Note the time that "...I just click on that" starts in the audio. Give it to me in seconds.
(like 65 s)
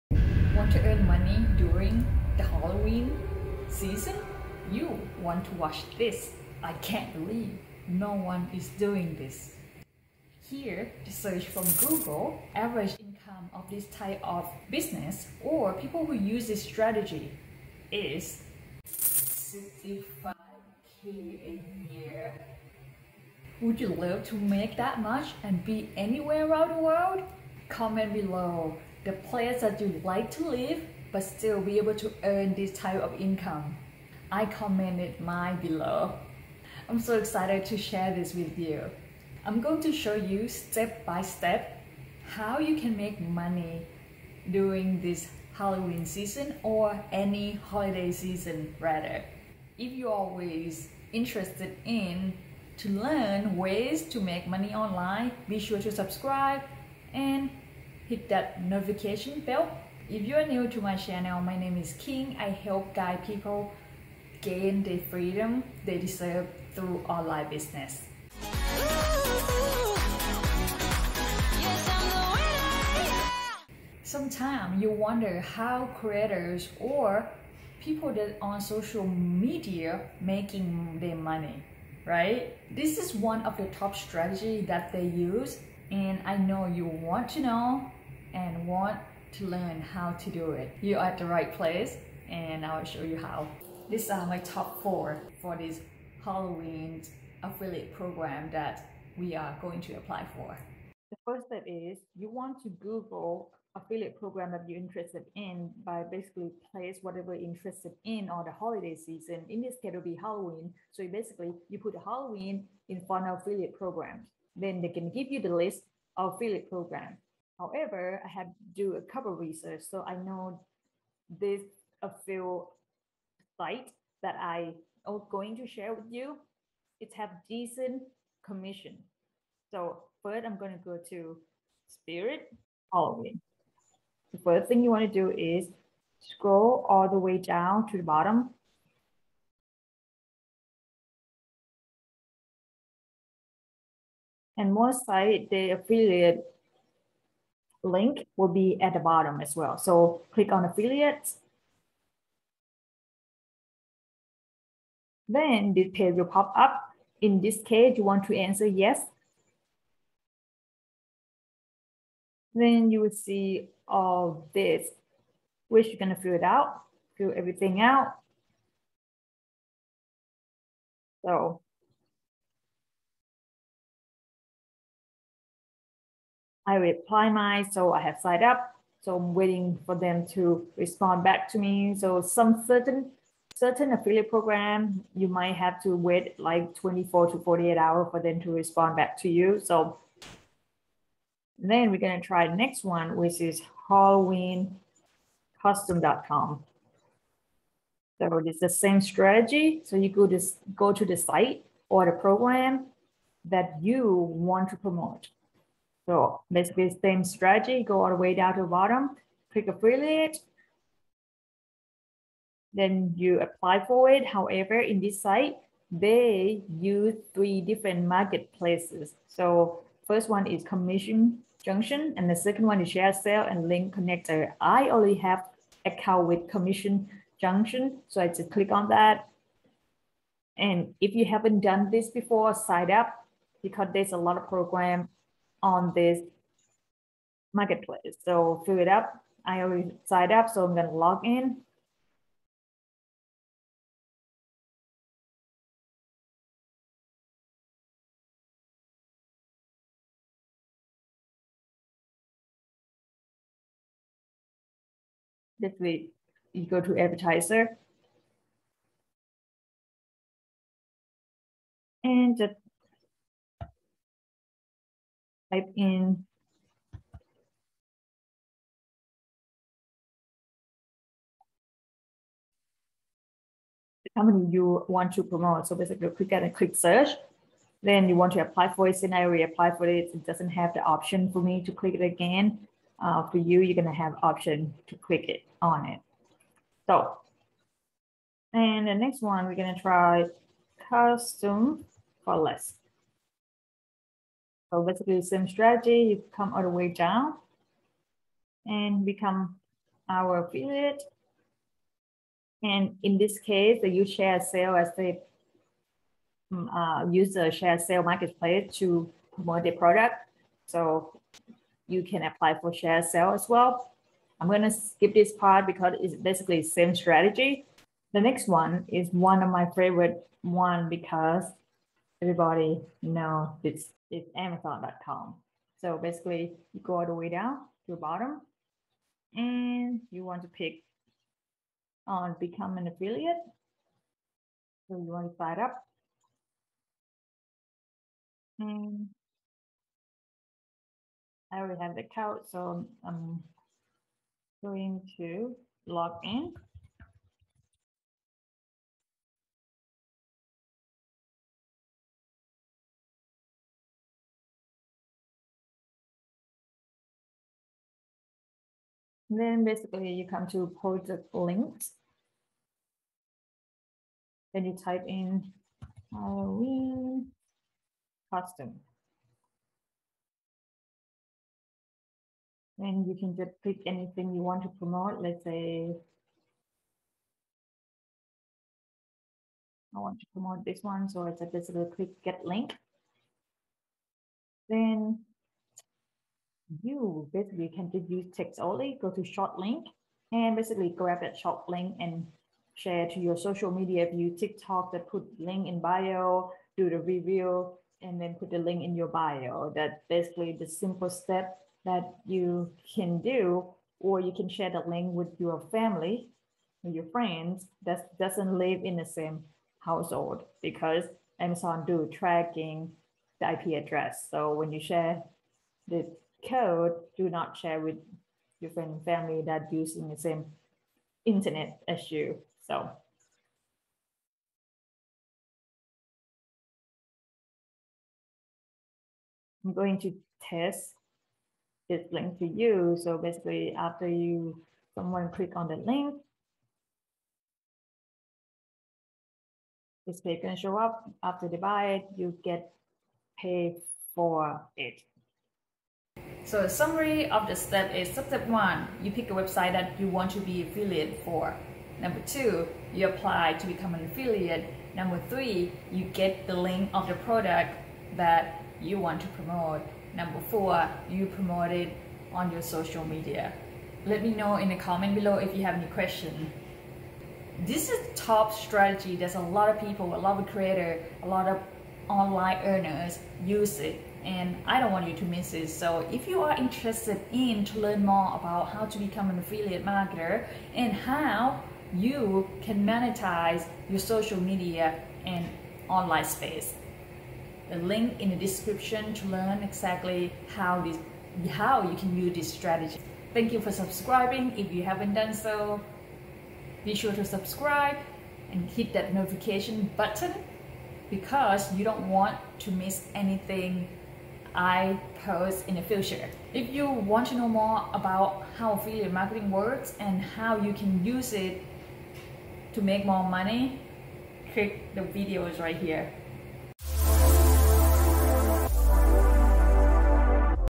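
228 s.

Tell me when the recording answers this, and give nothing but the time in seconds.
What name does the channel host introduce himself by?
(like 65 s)
61 s.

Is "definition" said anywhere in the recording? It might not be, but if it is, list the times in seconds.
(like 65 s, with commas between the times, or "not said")
not said.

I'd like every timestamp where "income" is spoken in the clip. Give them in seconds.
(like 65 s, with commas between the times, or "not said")
13 s, 33 s.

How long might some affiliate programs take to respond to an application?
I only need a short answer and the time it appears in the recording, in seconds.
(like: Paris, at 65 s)
24 to 48 hours, at 186 s.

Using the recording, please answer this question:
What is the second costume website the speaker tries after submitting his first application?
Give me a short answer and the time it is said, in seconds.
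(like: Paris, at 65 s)
HalloweenCustom.com, at 193 s.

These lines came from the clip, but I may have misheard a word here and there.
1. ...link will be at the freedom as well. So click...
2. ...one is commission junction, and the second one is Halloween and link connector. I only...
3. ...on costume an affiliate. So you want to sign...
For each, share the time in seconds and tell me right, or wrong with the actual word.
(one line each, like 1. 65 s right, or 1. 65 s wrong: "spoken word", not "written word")
1. 147 s wrong: "bottom", not "freedom"
2. 220 s wrong: "ShareASale", not "Halloween"
3. 332 s wrong: "become", not "costume".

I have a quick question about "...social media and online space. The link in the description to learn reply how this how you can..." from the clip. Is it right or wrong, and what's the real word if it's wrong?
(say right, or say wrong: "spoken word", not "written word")
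wrong: "exactly", not "reply".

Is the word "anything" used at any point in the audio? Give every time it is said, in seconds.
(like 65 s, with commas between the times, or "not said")
373 s, 503 s.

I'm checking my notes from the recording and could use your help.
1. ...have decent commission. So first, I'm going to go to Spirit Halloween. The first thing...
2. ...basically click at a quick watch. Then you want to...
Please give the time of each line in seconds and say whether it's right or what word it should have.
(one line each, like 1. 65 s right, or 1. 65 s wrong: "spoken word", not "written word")
1. 127 s right
2. 275 s wrong: "search", not "watch".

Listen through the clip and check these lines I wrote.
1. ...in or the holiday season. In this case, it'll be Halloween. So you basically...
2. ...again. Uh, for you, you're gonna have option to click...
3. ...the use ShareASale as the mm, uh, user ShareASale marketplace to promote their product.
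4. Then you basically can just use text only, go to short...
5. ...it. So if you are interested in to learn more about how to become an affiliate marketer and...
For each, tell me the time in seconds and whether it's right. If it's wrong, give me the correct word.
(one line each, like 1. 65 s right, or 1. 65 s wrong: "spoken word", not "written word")
1. 108 s right
2. 282 s right
3. 303 s right
4. 384 s right
5. 475 s right.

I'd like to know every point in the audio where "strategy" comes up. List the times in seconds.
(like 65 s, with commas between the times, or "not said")
16 s, 83 s, 199 s, 207 s, 295 s, 316 s, 468 s, 492 s.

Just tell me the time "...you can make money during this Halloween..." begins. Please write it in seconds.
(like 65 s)
42 s.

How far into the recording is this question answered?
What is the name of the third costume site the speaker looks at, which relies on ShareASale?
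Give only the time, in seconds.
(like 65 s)
290 s.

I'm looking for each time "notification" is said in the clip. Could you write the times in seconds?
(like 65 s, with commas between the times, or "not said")
58 s, 499 s.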